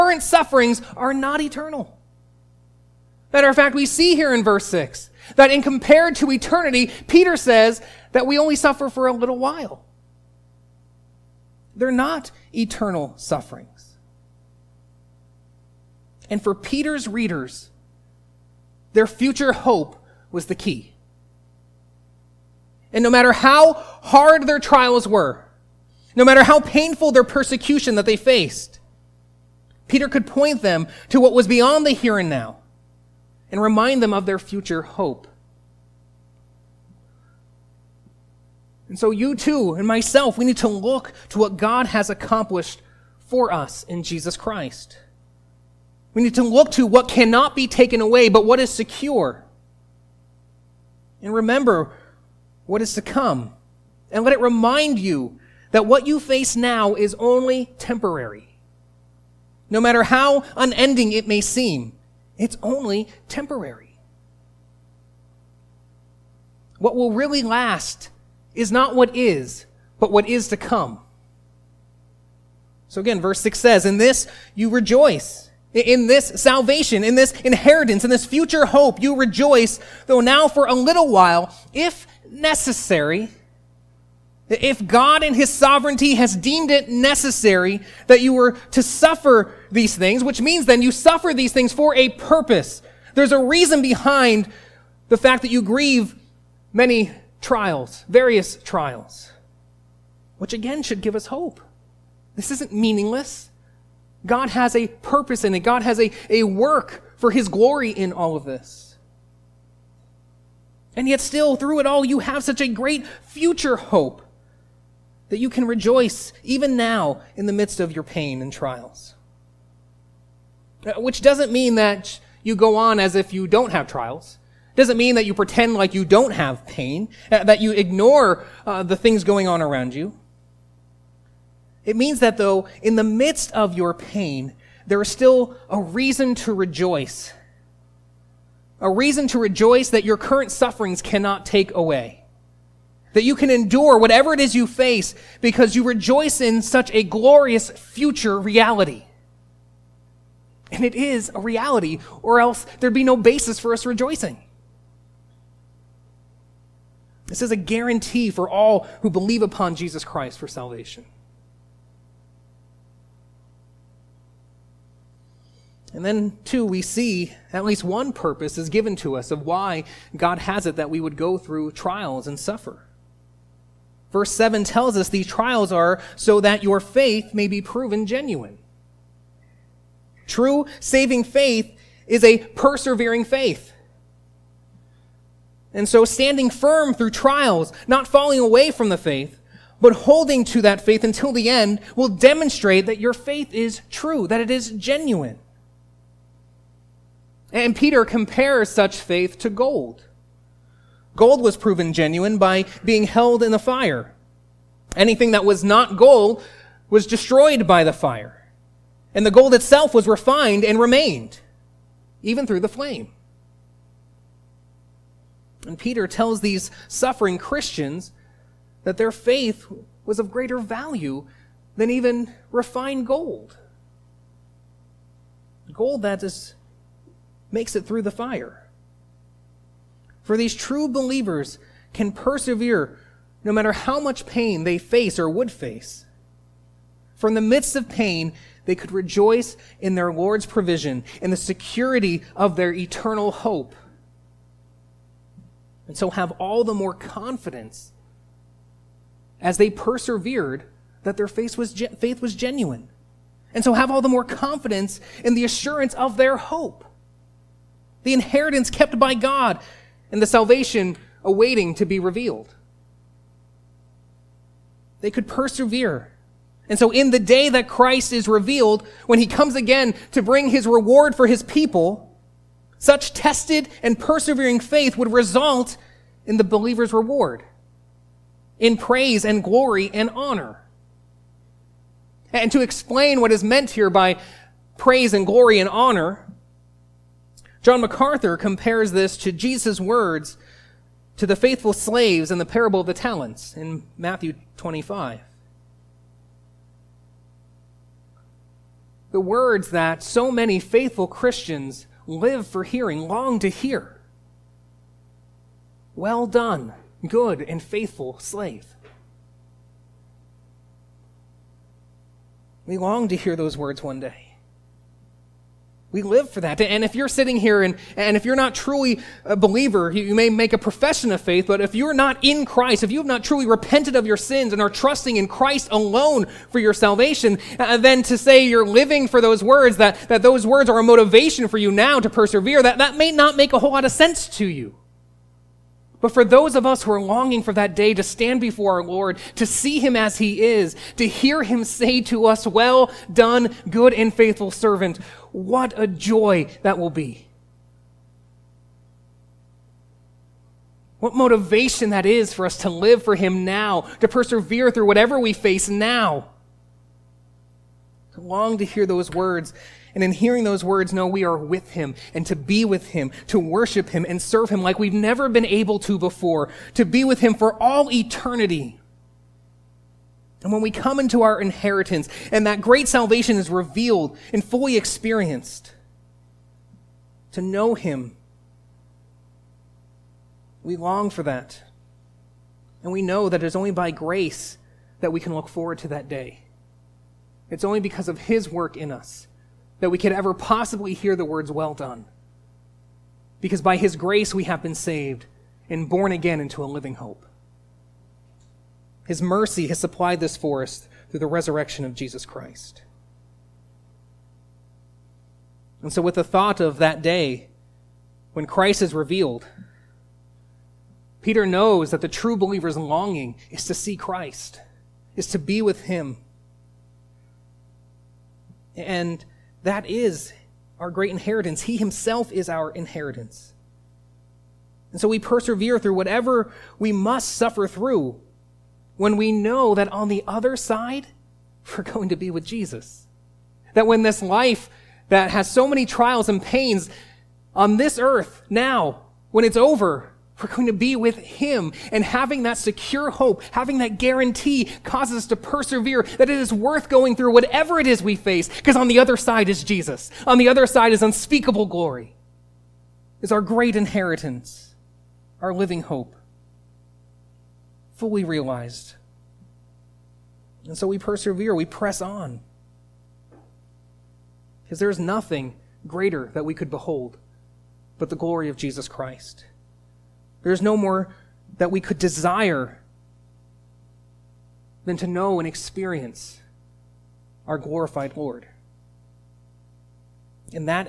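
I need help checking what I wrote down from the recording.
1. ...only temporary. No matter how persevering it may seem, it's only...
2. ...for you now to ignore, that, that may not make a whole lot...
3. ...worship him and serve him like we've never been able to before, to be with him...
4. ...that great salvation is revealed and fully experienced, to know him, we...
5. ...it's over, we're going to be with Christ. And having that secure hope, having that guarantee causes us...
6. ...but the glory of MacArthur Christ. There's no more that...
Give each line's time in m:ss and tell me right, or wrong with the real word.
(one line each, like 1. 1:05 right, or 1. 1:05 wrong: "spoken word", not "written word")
1. 0:57 wrong: "unending", not "persevering"
2. 5:31 wrong: "persevere", not "ignore"
3. 6:03 right
4. 6:12 right
5. 7:19 wrong: "Him", not "Christ"
6. 7:47 wrong: "Jesus", not "MacArthur".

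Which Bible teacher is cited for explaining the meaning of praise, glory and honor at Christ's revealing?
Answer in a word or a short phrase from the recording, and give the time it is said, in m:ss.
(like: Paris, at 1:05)
John MacArthur, at 4:47.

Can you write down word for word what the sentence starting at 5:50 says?
What motivation that is for us to live for him now, to persevere through whatever we face now.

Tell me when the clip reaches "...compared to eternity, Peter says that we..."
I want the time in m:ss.
0:05.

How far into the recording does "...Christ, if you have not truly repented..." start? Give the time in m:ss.
5:22.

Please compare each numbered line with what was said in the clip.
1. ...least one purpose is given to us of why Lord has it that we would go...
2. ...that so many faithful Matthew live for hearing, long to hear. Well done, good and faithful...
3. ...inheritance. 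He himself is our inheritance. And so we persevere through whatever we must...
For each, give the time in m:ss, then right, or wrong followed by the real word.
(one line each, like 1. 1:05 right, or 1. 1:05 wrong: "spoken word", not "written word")
1. 2:47 wrong: "God", not "Lord"
2. 4:59 wrong: "Christians", not "Matthew"
3. 7:01 right.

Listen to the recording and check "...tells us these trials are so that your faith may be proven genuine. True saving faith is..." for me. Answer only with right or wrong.
right.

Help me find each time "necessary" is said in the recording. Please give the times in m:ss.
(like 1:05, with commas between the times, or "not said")
1:22, 1:26.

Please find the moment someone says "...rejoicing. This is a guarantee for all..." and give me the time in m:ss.
2:33.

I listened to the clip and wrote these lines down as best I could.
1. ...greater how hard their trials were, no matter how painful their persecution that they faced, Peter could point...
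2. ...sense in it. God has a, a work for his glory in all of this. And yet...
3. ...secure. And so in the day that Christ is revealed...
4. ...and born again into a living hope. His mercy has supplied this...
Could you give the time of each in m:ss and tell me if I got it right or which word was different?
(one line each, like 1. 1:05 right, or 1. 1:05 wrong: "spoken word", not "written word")
1. 0:23 wrong: "matter", not "greater"
2. 1:44 wrong: "purpose", not "sense"
3. 4:25 wrong: "persevere", not "secure"
4. 6:35 right.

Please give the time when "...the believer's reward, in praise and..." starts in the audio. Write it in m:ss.
4:36.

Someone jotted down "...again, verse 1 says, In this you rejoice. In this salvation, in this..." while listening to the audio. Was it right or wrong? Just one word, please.
wrong.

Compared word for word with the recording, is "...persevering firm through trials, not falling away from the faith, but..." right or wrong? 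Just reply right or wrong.
wrong.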